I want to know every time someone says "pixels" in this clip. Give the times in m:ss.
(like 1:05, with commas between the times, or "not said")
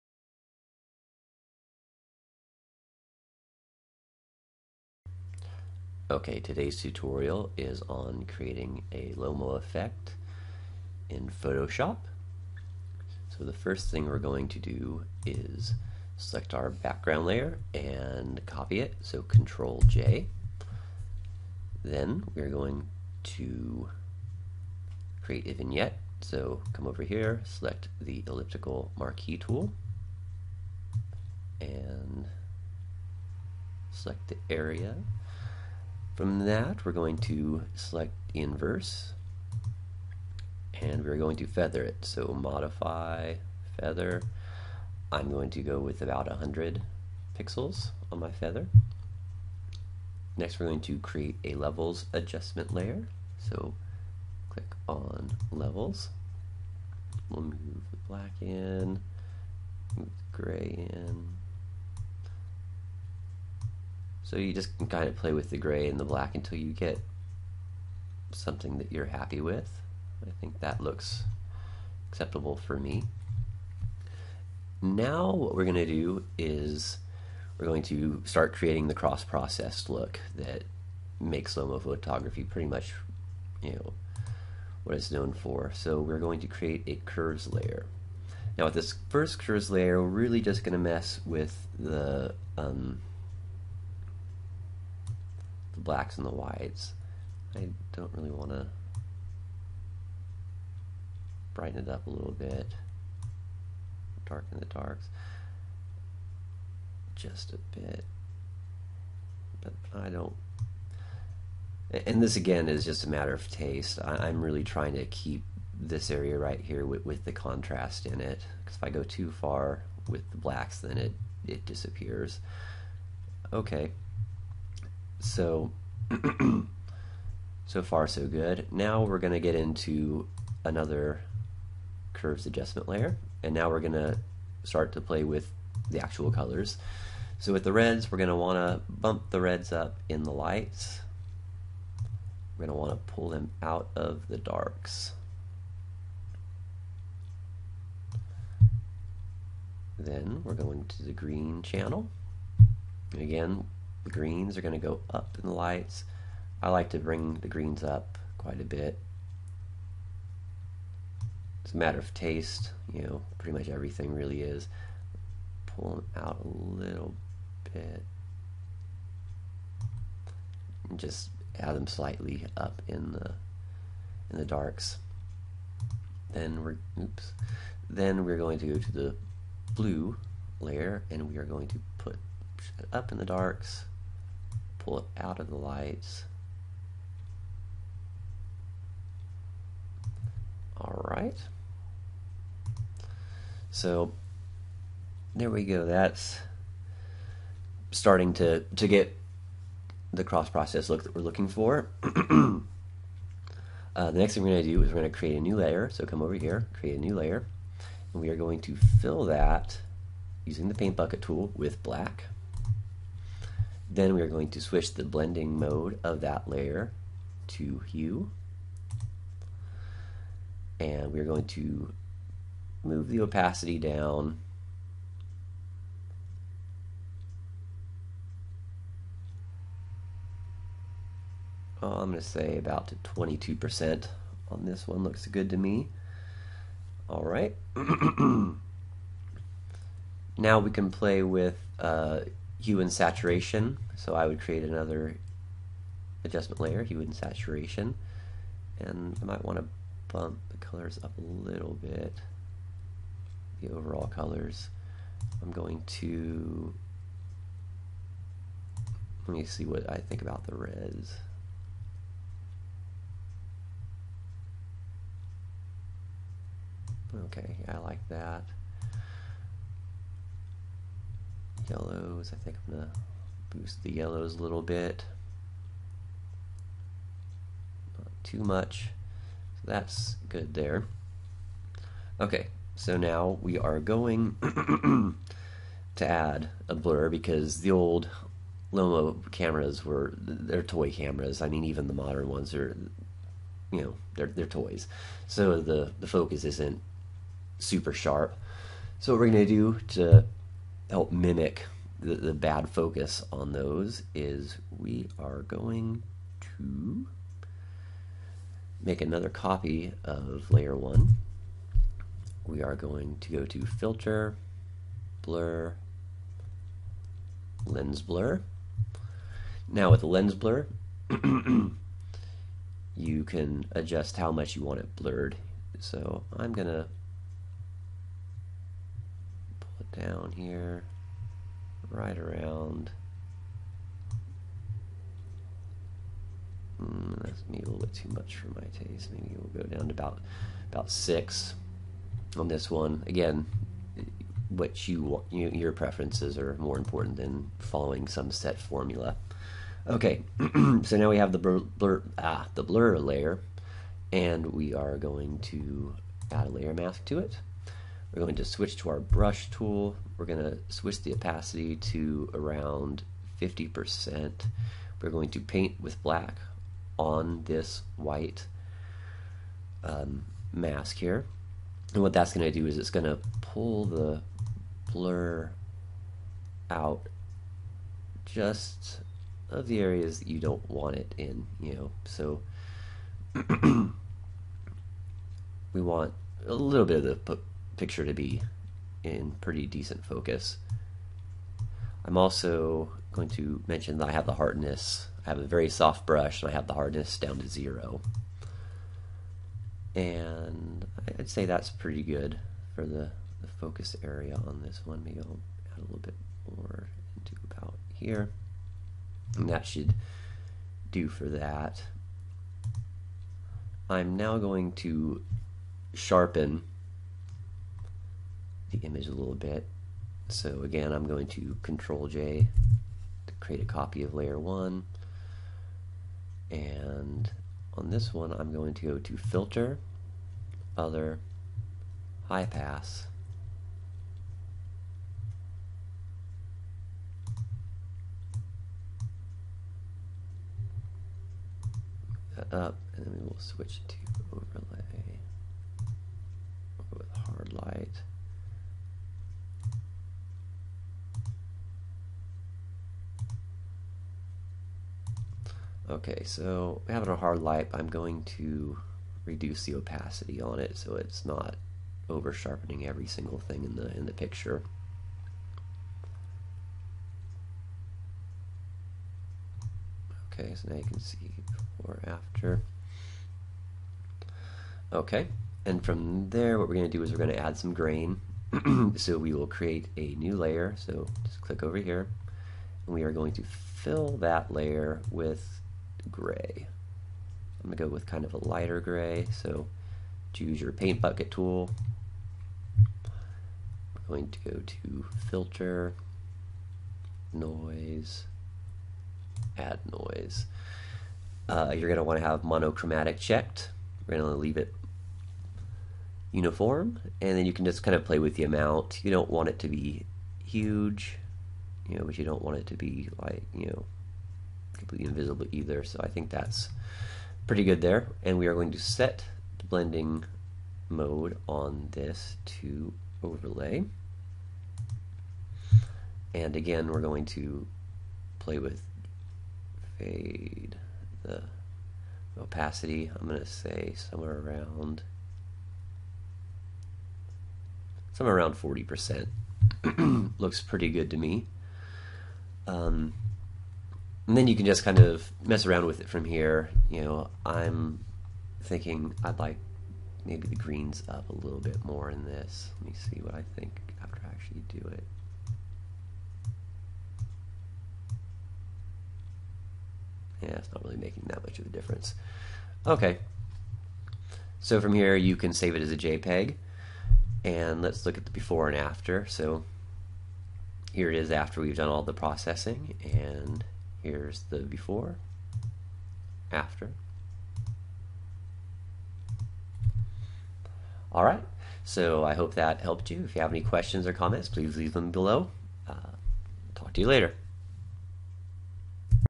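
0:47.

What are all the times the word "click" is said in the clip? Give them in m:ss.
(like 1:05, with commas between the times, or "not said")
0:54, 8:01.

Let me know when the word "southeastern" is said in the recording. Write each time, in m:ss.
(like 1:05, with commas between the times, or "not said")
not said.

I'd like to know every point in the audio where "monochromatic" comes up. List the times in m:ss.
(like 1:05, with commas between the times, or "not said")
8:22.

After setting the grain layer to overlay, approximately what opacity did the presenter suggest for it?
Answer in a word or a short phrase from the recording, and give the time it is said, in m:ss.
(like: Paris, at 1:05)
40%, at 8:58.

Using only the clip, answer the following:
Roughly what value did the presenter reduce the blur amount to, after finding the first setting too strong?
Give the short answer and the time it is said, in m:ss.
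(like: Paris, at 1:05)
6, at 5:40.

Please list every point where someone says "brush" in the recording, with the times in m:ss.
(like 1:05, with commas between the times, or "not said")
5:58, 6:36.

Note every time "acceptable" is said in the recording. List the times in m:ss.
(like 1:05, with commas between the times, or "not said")
1:12.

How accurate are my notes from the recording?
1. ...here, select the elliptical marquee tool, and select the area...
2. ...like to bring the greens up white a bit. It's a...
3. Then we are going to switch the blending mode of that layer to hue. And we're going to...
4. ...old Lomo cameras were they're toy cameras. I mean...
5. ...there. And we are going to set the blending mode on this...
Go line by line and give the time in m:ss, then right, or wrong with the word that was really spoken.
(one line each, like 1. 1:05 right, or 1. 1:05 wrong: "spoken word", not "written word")
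1. 0:27 right
2. 2:36 wrong: "quite", not "white"
3. 3:33 right
4. 4:47 right
5. 8:37 right.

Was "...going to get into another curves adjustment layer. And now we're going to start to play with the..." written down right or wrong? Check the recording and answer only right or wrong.
right.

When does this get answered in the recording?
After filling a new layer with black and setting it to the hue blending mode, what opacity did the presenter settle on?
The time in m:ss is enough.
3:52.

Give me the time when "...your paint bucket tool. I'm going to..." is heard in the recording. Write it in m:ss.
8:10.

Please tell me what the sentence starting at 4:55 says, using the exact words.
So the the focus isn't super sharp.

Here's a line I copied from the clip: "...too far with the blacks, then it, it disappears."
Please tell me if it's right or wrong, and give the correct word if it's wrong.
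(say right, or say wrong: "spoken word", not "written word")
right.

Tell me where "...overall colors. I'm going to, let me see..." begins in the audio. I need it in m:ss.
4:13.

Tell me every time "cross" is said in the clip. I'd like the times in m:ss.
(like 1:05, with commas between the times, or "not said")
1:18, 3:20.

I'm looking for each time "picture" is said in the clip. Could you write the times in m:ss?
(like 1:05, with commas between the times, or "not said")
6:27, 7:44.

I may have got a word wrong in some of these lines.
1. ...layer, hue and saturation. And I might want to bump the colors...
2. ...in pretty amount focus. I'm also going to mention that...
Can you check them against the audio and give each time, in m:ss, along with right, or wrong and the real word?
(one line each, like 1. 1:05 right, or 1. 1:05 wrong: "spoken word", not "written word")
1. 4:06 right
2. 6:29 wrong: "decent", not "amount".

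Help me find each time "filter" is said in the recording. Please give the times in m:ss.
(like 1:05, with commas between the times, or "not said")
5:13, 7:09, 8:15.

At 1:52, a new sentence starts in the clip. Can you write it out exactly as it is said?
And this again is just a matter of taste.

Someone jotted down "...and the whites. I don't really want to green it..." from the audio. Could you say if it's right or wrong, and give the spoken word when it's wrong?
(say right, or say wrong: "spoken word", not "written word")
wrong: "brighten", not "green".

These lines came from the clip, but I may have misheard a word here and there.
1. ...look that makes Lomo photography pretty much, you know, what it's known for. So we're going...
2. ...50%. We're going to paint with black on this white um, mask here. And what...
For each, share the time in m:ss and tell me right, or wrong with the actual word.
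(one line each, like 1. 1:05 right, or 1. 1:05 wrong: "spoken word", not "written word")
1. 1:19 right
2. 6:03 right.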